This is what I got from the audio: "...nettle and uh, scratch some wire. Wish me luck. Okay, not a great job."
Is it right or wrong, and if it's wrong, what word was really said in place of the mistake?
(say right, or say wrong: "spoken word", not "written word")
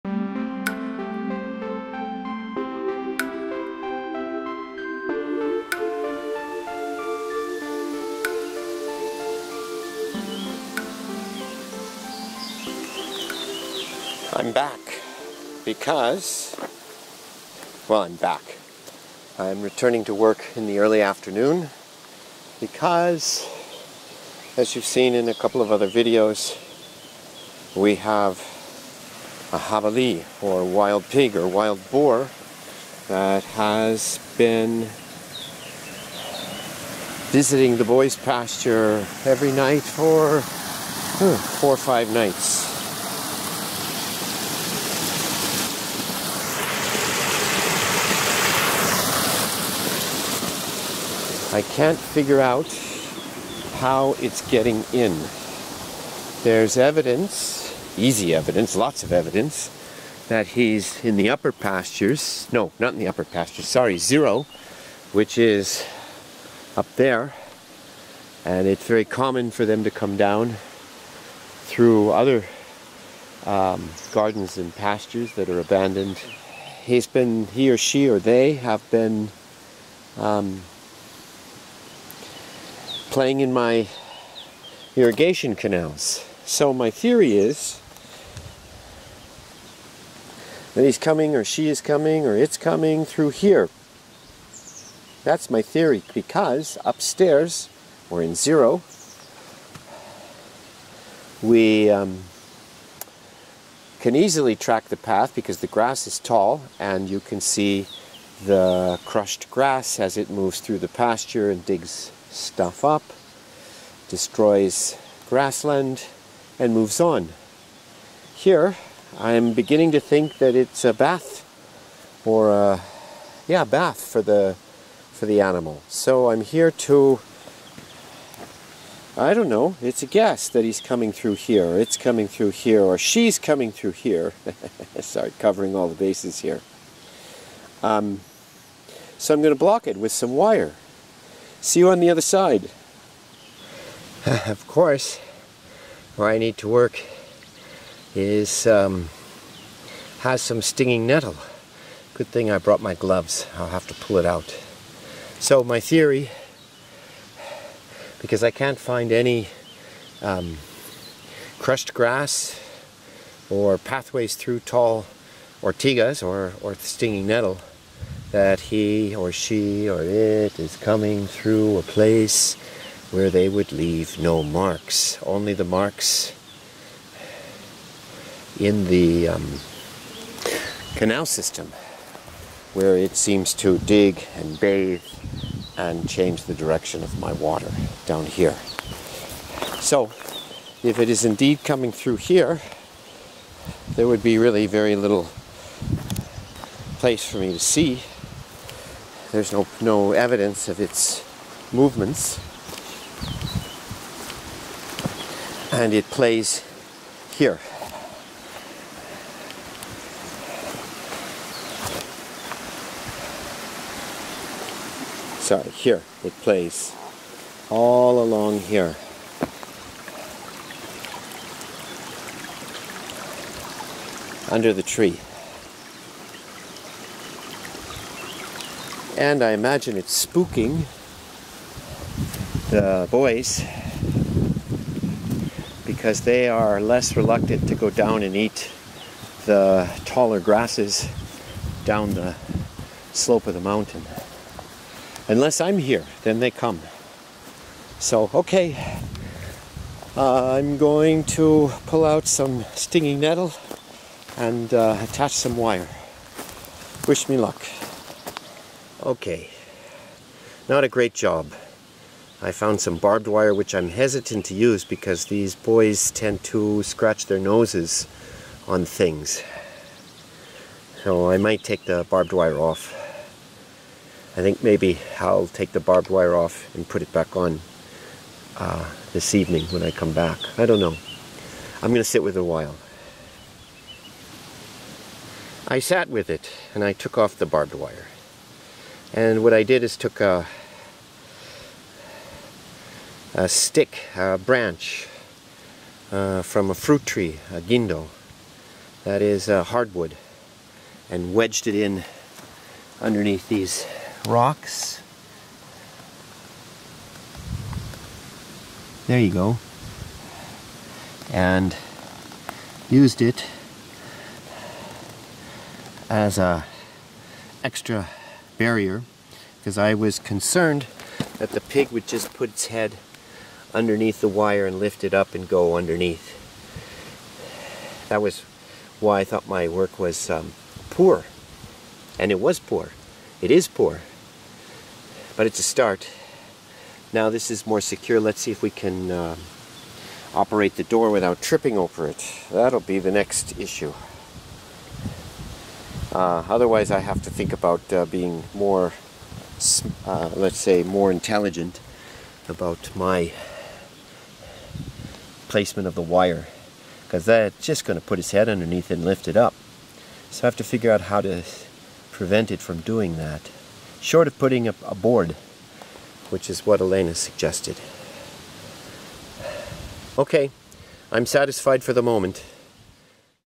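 wrong: "attach", not "scratch".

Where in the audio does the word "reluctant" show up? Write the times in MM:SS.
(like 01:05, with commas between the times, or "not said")
03:57.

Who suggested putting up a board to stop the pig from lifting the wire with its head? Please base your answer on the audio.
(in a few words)
Elena.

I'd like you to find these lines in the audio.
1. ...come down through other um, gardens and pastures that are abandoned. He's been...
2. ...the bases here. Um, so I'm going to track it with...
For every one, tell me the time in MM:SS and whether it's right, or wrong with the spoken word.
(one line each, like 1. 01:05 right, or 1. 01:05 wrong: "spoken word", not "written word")
1. 01:09 right
2. 02:15 wrong: "block", not "track".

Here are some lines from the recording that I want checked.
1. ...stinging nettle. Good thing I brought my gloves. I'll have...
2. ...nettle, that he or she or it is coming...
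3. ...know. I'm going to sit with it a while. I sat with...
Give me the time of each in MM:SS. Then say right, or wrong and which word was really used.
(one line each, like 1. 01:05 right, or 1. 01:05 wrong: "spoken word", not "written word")
1. 02:30 right
2. 02:47 right
3. 04:40 right.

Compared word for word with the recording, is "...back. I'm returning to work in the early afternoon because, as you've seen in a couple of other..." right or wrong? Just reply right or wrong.
right.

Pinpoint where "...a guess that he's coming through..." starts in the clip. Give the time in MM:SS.
02:10.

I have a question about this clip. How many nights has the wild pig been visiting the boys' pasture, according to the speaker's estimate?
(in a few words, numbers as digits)
4 or 5.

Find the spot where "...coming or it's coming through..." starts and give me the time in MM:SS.
01:31.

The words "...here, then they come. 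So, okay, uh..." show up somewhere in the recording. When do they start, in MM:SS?
04:05.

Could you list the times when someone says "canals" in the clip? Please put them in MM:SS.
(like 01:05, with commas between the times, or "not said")
01:25, 03:00.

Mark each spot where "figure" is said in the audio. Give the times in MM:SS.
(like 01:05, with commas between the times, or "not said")
00:51, 06:00.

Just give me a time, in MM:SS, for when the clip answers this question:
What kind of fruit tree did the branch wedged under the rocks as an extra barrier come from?
04:57.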